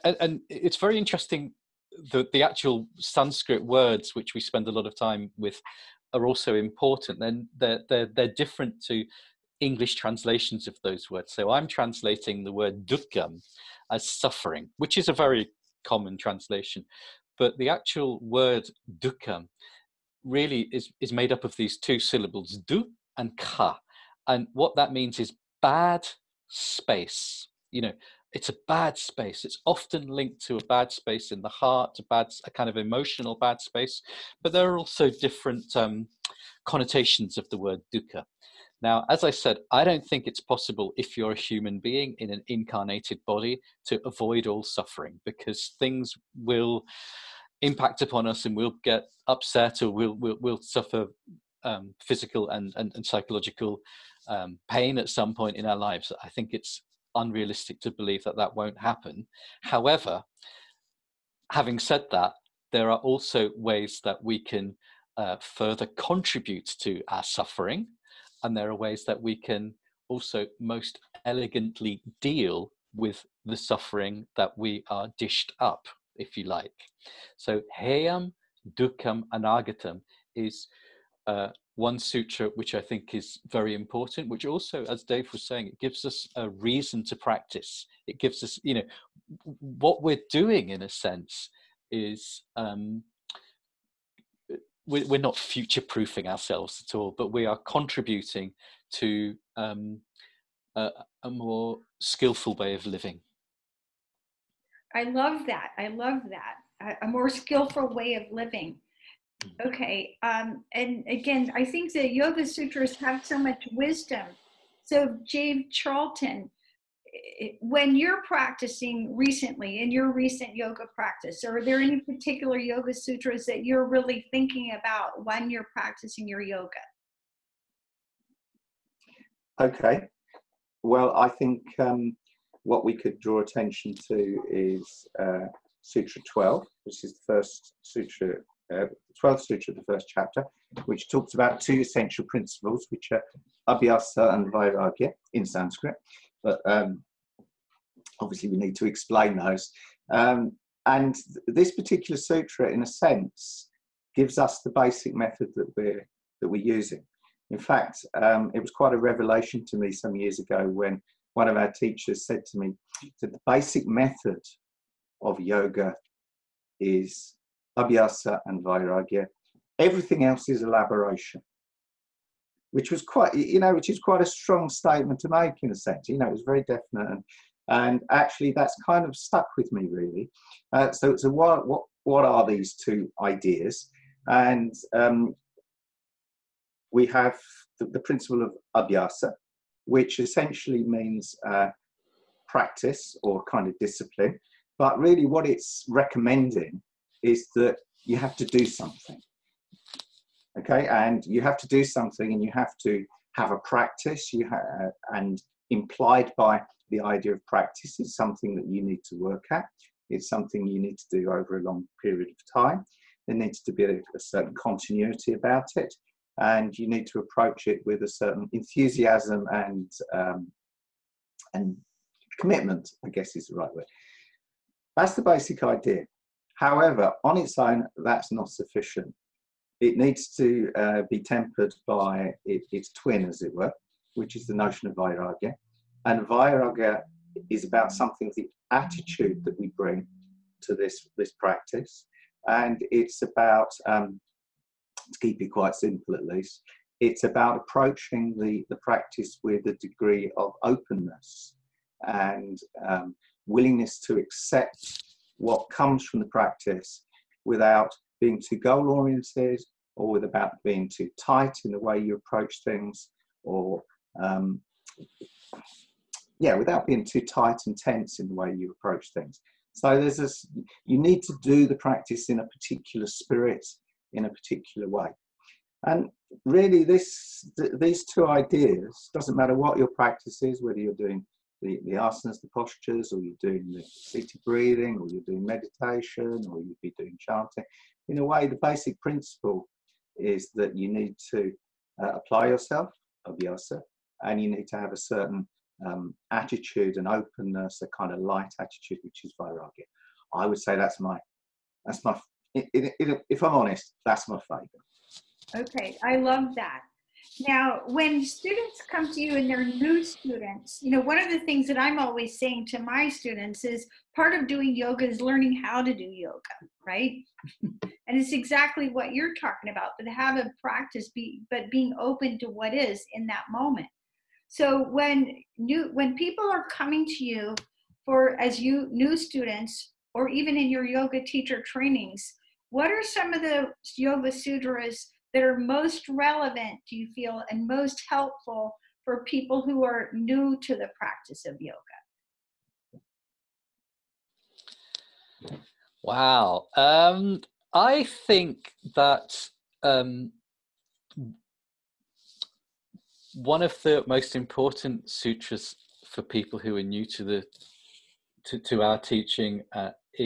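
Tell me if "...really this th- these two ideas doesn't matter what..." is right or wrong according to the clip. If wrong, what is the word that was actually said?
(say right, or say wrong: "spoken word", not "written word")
right.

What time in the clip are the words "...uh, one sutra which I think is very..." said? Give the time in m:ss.
1:21.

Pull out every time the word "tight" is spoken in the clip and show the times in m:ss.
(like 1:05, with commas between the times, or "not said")
4:21, 4:27.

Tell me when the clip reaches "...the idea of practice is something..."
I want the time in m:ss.
3:26.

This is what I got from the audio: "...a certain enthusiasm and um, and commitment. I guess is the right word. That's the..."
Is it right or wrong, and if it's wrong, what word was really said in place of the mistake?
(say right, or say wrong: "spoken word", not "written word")
right.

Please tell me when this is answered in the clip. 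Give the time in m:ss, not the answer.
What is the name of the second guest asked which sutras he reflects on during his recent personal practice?
1:55.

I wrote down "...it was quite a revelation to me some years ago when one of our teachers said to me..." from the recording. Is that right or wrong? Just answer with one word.
right.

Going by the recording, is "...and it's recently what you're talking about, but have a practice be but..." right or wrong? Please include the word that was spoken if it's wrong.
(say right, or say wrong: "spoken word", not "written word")
wrong: "exactly", not "recently".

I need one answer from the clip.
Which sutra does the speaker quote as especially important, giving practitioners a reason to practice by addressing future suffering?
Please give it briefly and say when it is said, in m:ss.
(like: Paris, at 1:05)
heyam dukkam anagatam, at 1:17.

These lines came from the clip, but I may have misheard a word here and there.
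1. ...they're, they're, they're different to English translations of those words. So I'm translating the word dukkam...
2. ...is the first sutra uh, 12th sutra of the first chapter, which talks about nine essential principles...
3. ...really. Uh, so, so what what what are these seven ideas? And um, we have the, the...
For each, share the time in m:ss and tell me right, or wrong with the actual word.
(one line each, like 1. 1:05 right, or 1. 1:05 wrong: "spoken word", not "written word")
1. 0:07 right
2. 2:17 wrong: "two", not "nine"
3. 2:59 wrong: "two", not "seven".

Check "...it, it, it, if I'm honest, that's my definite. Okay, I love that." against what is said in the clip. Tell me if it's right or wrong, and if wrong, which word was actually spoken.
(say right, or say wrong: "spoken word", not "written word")
wrong: "favorite", not "definite".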